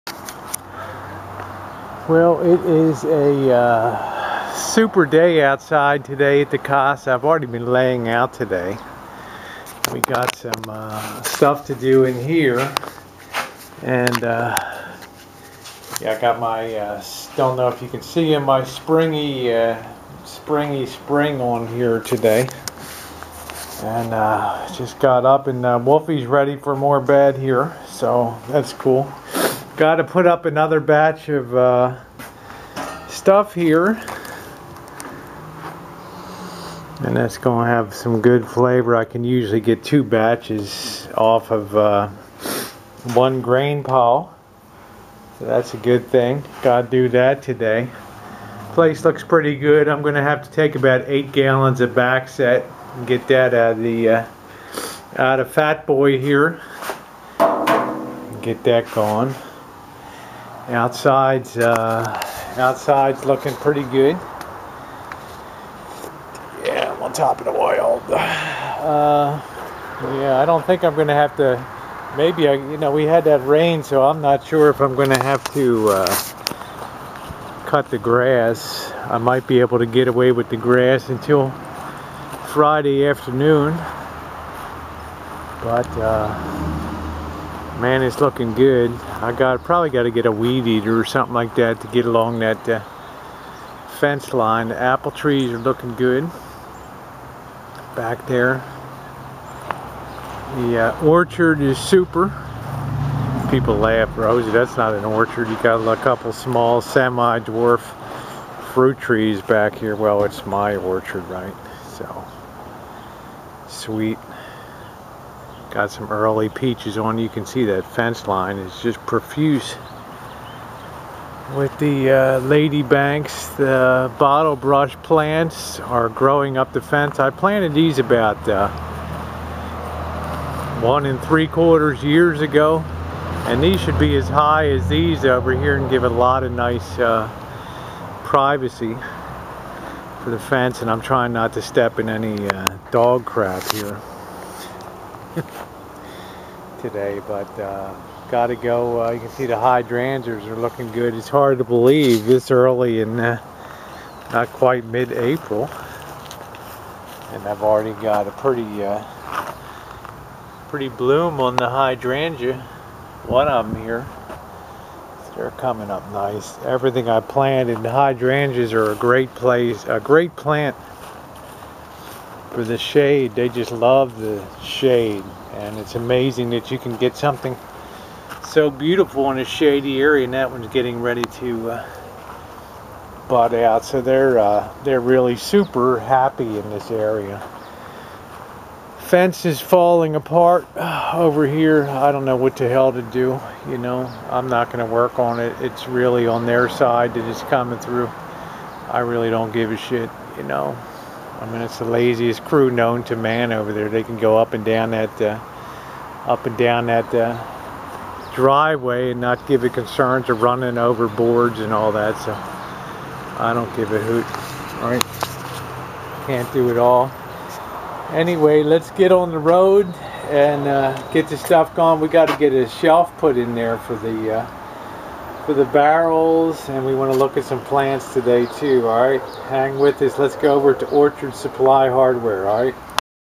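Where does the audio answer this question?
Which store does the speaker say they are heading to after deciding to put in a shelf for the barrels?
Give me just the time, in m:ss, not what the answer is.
3:50.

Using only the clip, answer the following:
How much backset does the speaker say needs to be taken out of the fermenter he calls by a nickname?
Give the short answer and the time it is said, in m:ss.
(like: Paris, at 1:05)
8 gallons, at 0:51.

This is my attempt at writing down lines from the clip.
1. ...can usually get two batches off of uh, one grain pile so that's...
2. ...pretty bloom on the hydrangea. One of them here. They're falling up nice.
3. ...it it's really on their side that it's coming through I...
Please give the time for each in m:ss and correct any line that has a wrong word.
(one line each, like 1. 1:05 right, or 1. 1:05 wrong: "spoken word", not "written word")
1. 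0:39 right
2. 2:40 wrong: "coming", not "falling"
3. 3:15 right.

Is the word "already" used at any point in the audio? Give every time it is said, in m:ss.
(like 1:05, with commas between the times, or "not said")
0:07, 2:37.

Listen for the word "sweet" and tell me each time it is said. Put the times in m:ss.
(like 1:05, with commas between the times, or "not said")
1:53.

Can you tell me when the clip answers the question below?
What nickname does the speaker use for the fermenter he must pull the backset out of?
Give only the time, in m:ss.
0:55.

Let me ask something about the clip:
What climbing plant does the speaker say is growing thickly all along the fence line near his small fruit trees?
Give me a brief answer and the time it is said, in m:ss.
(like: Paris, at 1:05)
Lady Banks, at 2:02.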